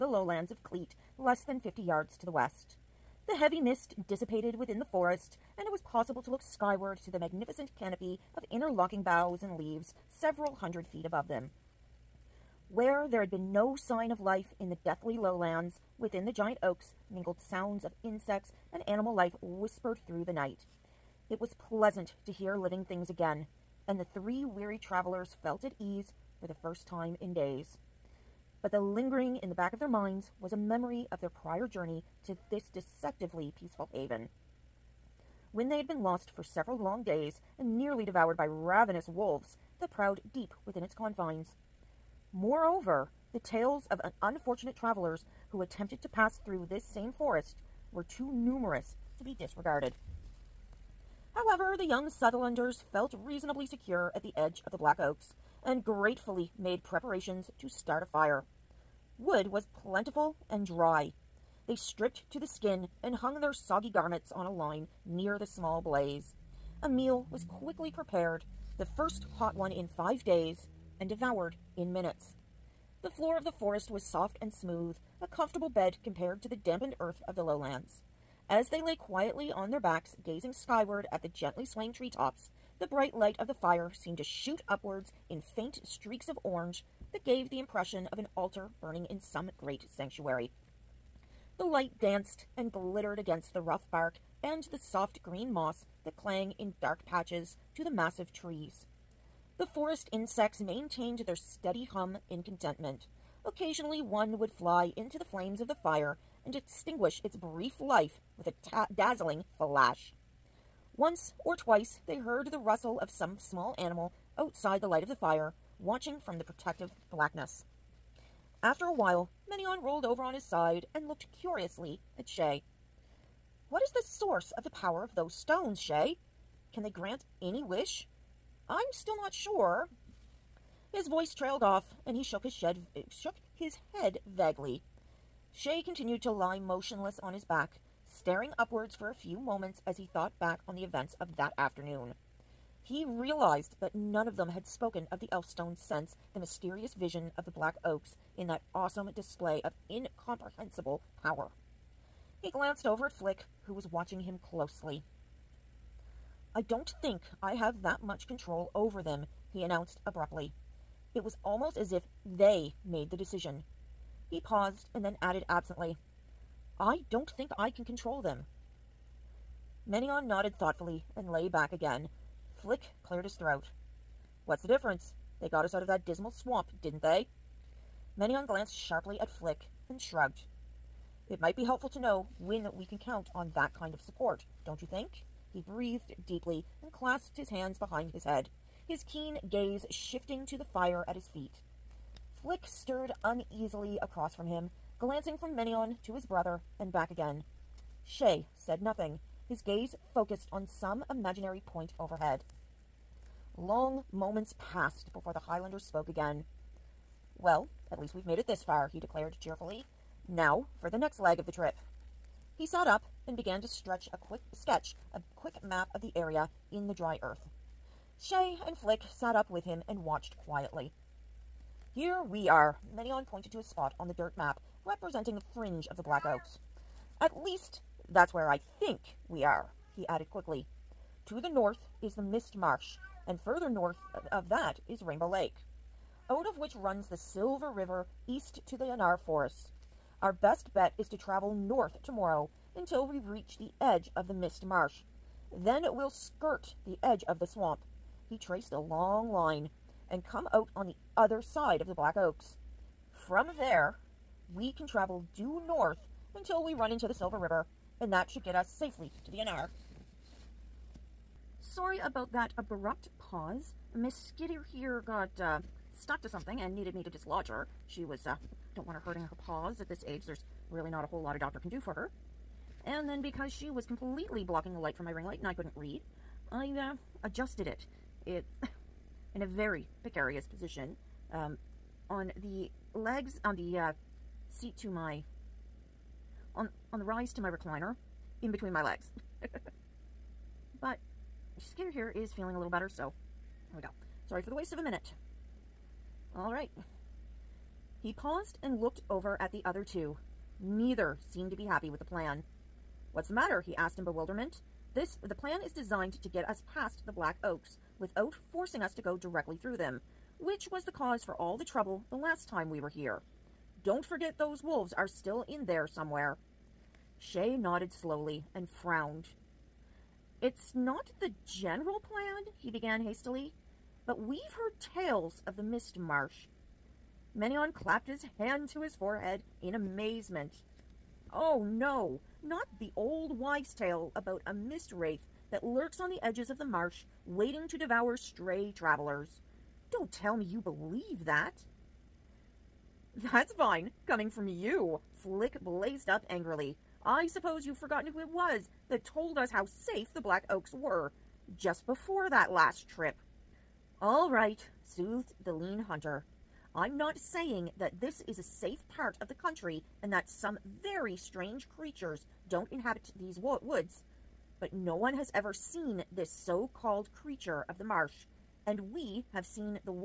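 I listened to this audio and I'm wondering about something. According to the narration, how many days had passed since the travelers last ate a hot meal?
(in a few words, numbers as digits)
5.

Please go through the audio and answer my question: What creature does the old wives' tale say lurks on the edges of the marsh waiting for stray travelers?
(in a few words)
mist wraith.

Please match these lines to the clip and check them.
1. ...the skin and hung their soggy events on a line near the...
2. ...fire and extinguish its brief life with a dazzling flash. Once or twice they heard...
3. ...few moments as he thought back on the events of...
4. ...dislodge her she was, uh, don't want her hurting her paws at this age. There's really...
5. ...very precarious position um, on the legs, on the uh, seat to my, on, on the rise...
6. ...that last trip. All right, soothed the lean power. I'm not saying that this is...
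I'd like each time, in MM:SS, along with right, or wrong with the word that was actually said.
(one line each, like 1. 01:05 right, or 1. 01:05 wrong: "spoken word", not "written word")
1. 01:02 wrong: "garments", not "events"
2. 01:45 right
3. 02:19 right
4. 04:27 right
5. 04:39 right
6. 05:52 wrong: "hunter", not "power".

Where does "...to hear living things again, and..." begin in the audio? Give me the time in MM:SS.
00:22.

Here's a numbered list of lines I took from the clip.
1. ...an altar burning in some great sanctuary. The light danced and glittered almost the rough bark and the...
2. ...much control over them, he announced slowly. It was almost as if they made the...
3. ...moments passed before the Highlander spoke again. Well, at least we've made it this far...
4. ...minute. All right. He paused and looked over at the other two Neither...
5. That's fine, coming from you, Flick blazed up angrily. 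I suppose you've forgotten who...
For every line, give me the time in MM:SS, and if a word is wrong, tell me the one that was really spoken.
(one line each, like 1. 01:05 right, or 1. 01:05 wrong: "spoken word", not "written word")
1. 01:28 wrong: "against", not "almost"
2. 02:38 wrong: "abruptly", not "slowly"
3. 03:24 right
4. 04:54 right
5. 05:43 right.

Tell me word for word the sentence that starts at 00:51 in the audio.
However, the young Southlanders felt reasonably secure at the edge of the Black Oaks and gratefully made preparations to start a fire.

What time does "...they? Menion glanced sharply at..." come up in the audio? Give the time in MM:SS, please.
02:57.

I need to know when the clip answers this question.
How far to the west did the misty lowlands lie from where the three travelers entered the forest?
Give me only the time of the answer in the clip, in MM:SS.
00:01.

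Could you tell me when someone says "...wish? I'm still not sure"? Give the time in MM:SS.
02:07.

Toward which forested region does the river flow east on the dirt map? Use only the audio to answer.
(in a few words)
Anar Forests.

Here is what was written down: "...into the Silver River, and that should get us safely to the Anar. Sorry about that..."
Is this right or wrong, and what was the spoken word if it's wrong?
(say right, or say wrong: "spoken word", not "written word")
right.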